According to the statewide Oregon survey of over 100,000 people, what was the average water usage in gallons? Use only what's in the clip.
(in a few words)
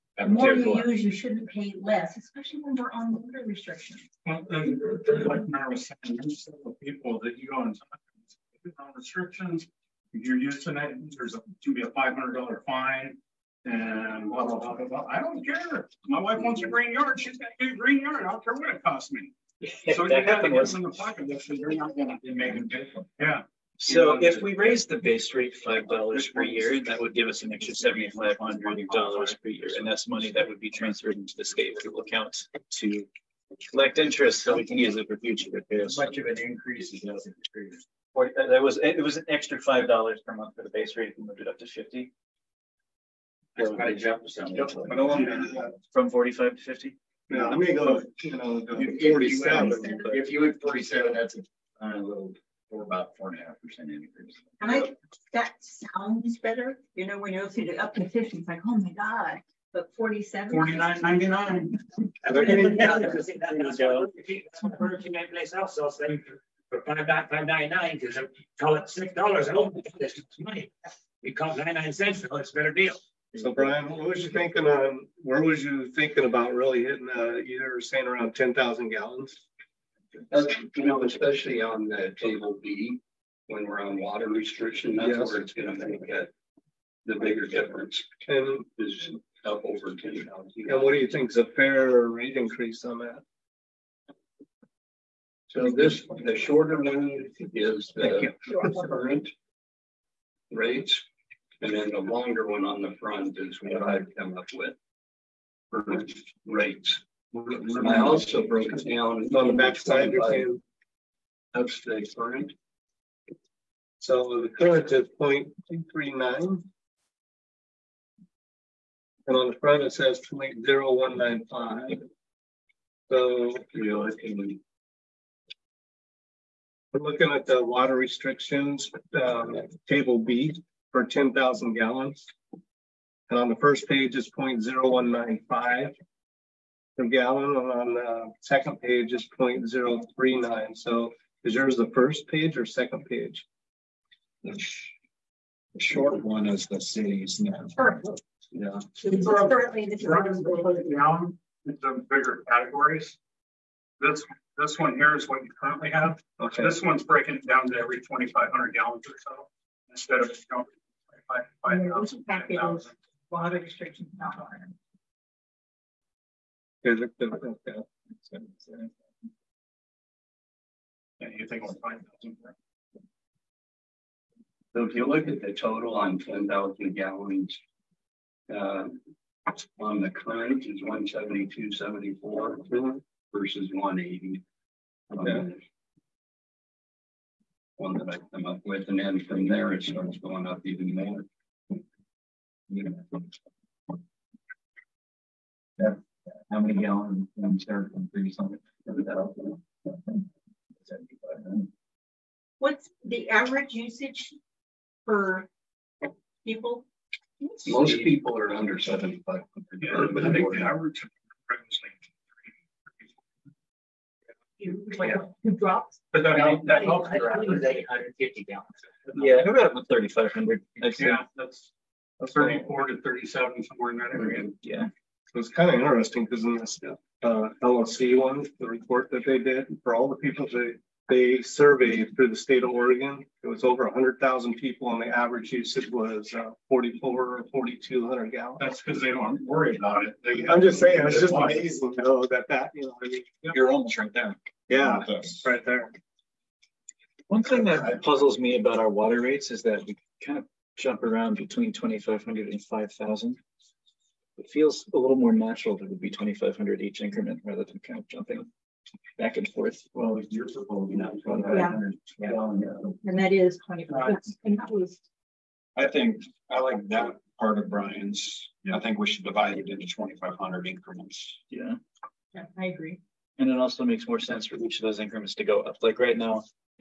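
4,200.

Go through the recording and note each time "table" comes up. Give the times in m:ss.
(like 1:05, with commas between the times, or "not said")
1:22, 2:09.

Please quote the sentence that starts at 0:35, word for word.
Much of an increase is nothing.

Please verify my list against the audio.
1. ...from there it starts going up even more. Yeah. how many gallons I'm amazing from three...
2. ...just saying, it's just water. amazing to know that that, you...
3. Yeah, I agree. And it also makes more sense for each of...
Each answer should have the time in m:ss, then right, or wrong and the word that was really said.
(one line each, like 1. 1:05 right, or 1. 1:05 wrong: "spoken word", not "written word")
1. 3:09 wrong: "starting", not "amazing"
2. 4:00 right
3. 4:32 right.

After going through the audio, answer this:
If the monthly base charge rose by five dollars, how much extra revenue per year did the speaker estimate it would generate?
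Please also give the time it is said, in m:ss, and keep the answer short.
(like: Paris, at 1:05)
$7,500, at 0:27.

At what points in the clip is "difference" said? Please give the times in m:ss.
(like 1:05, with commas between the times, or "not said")
0:22, 1:27.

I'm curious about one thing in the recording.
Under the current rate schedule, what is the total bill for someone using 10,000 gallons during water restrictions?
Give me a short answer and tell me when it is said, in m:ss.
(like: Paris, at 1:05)
172.74, at 3:00.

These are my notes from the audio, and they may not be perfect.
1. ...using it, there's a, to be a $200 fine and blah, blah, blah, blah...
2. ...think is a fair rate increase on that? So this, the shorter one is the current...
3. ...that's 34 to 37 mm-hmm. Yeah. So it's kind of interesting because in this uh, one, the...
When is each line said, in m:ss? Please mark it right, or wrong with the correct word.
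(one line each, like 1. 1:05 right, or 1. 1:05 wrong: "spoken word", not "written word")
1. 0:10 wrong: "500", not "200"
2. 1:31 right
3. 3:41 right.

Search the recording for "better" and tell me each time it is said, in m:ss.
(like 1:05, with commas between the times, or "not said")
0:56, 1:12.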